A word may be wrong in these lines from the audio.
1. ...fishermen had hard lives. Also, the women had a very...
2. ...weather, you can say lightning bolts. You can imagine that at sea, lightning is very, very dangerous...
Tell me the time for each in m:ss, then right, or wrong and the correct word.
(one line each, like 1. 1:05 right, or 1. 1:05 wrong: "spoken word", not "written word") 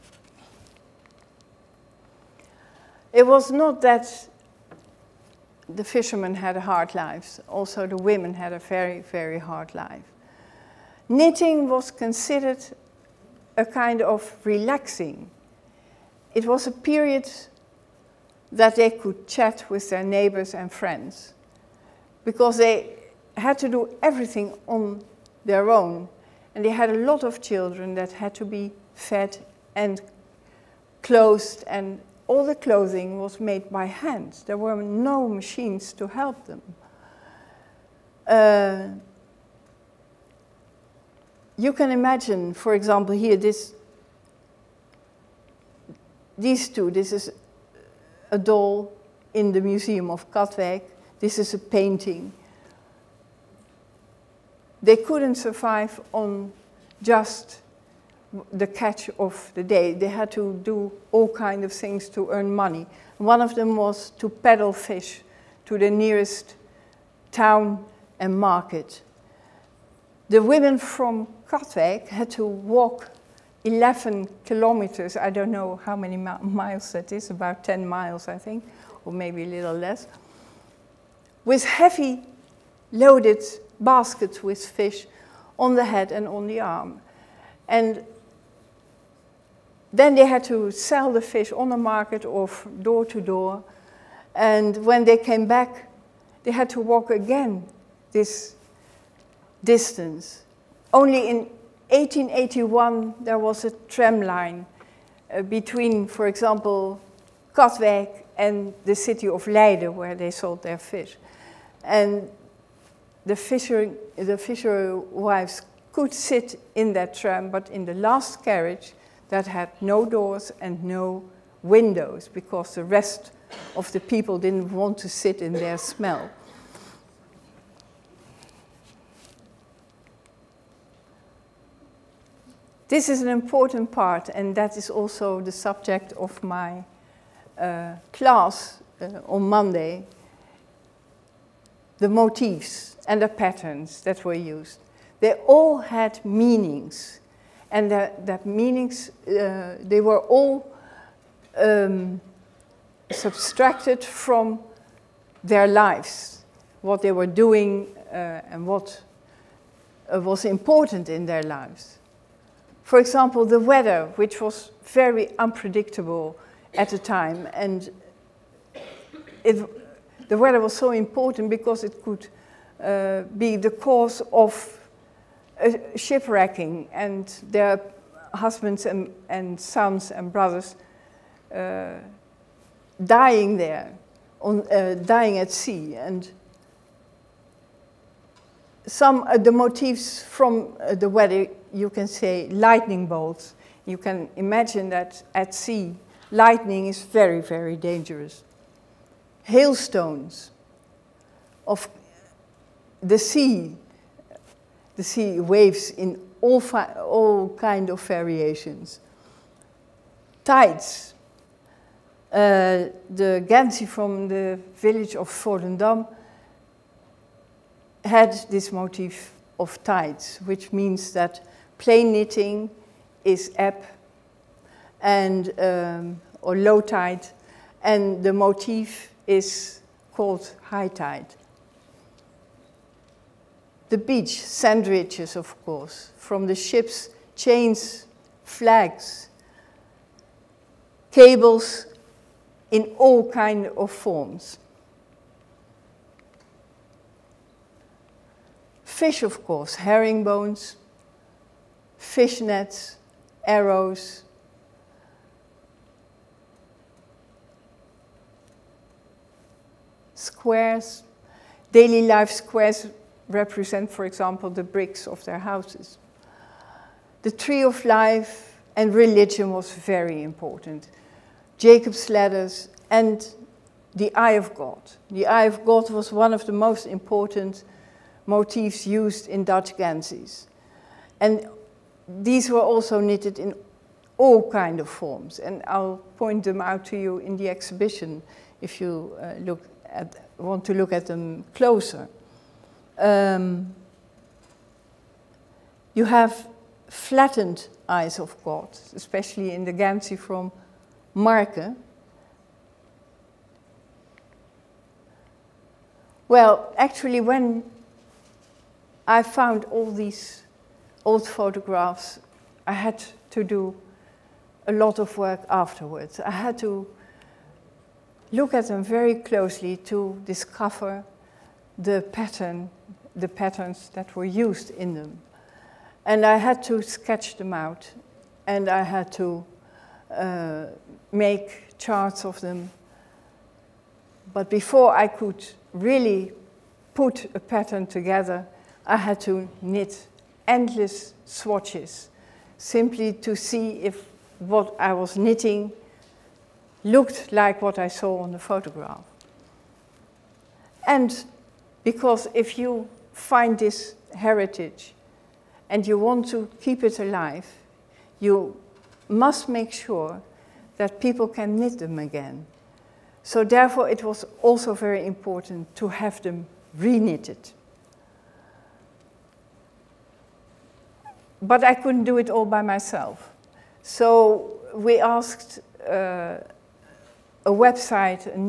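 1. 0:05 right
2. 3:11 right.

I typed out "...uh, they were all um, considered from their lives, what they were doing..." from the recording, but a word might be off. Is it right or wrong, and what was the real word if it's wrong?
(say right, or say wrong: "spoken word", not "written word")
wrong: "subtracted", not "considered".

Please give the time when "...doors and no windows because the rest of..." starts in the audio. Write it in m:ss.
2:00.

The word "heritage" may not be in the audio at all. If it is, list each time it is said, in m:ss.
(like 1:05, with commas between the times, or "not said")
5:54.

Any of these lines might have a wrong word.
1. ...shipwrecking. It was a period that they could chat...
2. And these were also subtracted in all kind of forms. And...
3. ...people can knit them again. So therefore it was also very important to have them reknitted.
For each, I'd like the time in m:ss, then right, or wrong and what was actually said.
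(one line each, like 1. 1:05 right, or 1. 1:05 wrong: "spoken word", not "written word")
1. 0:14 wrong: "relaxing", not "shipwrecking"
2. 4:41 wrong: "knitted", not "subtracted"
3. 6:00 right.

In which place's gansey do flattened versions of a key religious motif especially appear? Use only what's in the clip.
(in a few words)
Marke.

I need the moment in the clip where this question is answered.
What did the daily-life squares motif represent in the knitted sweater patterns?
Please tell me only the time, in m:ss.
4:24.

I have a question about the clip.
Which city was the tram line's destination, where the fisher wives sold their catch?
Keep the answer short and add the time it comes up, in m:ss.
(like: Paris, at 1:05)
Leiden, at 1:49.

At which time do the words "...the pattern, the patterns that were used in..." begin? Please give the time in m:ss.
5:21.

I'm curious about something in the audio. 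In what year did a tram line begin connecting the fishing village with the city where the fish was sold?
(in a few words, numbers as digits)
1881.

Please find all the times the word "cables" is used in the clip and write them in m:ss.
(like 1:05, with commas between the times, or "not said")
4:01.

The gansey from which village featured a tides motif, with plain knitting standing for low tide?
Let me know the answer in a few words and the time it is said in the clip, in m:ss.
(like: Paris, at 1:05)
Volendam, at 3:35.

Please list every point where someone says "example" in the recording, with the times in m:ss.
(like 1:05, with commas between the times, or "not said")
0:42, 1:46, 2:42, 4:24.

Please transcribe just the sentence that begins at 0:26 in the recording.
And they had a lot of children that had to be fed and clothed, and all the clothing was made by hand.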